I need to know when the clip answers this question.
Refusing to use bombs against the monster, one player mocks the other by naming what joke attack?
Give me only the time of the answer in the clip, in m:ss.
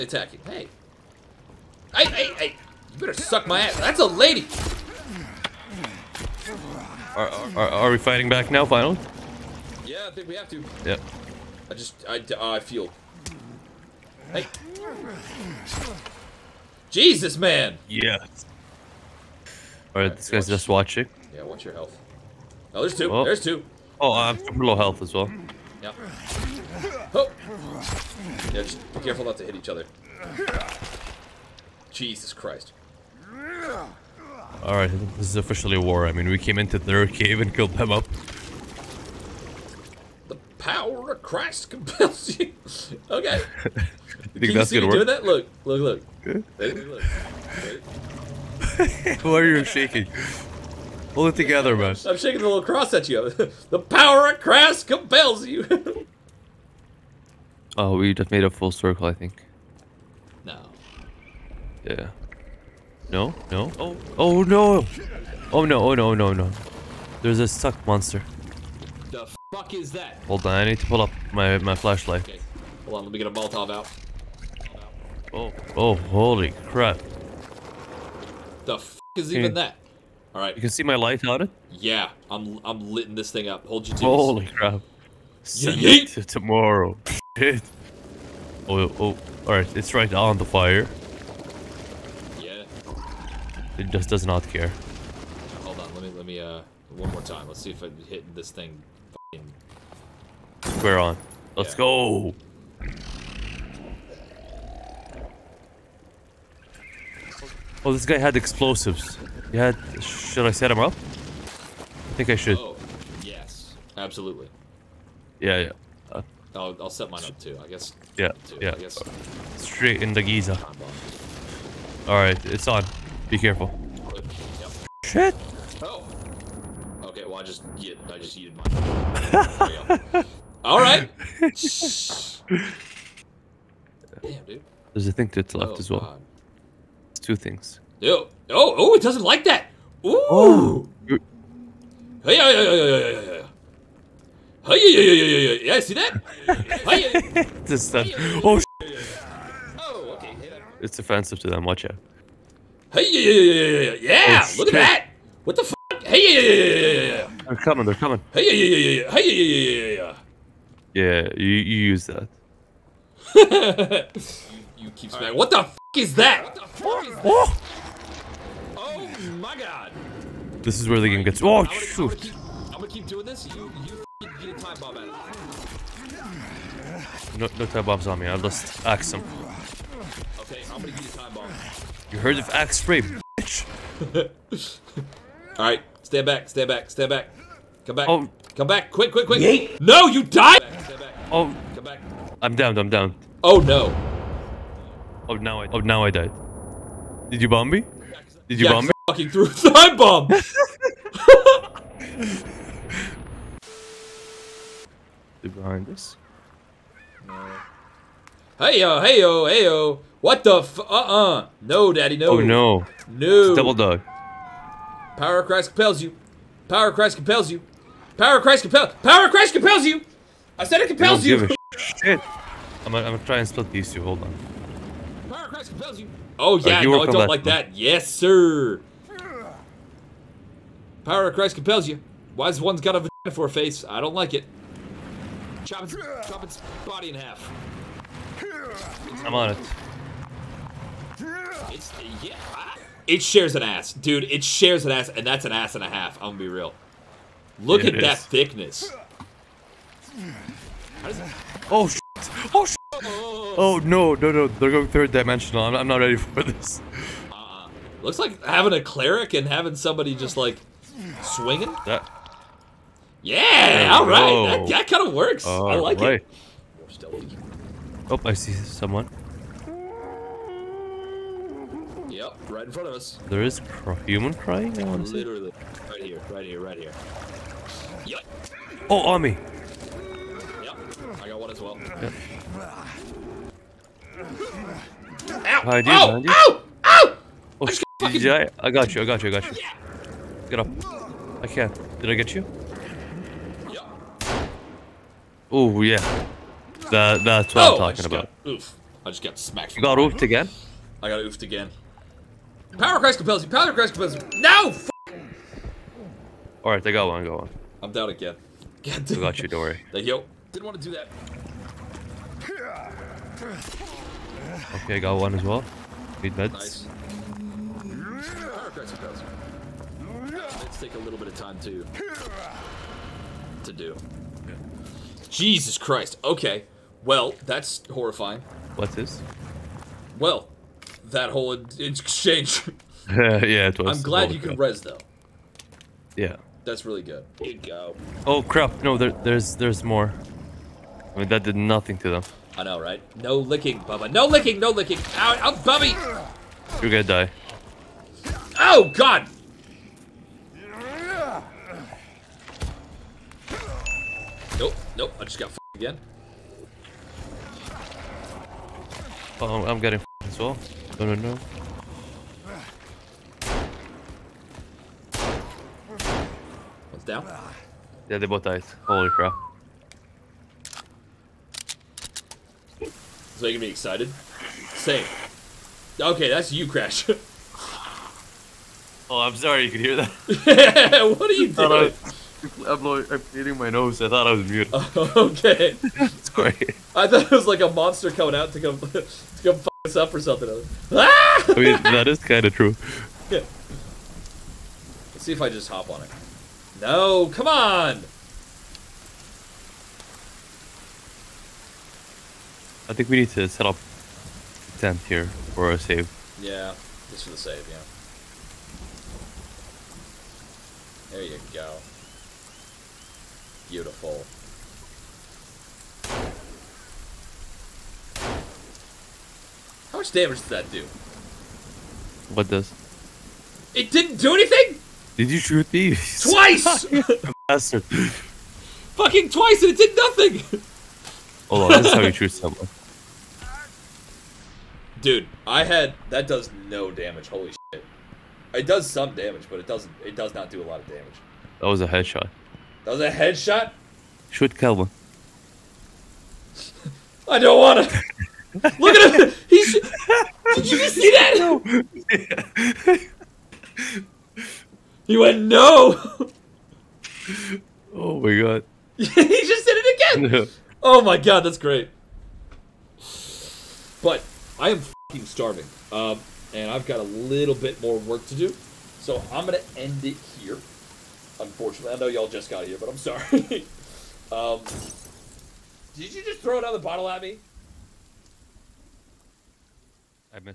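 3:02.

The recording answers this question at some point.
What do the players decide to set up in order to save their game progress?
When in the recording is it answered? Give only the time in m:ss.
6:44.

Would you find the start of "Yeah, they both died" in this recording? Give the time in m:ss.
6:08.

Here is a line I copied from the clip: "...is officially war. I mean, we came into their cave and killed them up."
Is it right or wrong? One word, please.
right.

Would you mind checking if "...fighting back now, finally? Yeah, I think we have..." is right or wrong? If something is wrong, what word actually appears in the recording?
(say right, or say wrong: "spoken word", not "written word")
right.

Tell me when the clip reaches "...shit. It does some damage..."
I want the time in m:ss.
7:17.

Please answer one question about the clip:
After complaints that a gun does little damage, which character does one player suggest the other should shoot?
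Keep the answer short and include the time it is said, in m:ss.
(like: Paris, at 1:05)
Kelvin, at 7:24.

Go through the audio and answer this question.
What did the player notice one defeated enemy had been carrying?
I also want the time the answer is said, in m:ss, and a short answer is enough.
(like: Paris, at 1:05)
Explosives, at 1:48.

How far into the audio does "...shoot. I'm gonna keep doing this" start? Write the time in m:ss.
2:51.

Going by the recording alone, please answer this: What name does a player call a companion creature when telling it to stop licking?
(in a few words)
Bubba.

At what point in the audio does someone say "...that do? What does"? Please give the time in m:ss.
7:00.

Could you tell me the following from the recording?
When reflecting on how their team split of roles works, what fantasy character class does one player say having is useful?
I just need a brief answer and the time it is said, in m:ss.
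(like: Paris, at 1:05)
Cleric, at 4:18.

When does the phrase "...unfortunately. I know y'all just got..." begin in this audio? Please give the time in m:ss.
7:51.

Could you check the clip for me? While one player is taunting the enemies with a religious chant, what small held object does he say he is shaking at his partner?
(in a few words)
Little cross.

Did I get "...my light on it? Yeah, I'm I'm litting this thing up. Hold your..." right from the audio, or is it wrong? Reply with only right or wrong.
right.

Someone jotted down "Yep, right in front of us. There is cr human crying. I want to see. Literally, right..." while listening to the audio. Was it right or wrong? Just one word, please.
right.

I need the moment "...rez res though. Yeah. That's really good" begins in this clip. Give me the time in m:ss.
5:34.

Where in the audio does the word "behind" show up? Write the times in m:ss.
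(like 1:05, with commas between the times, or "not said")
3:25, 4:45.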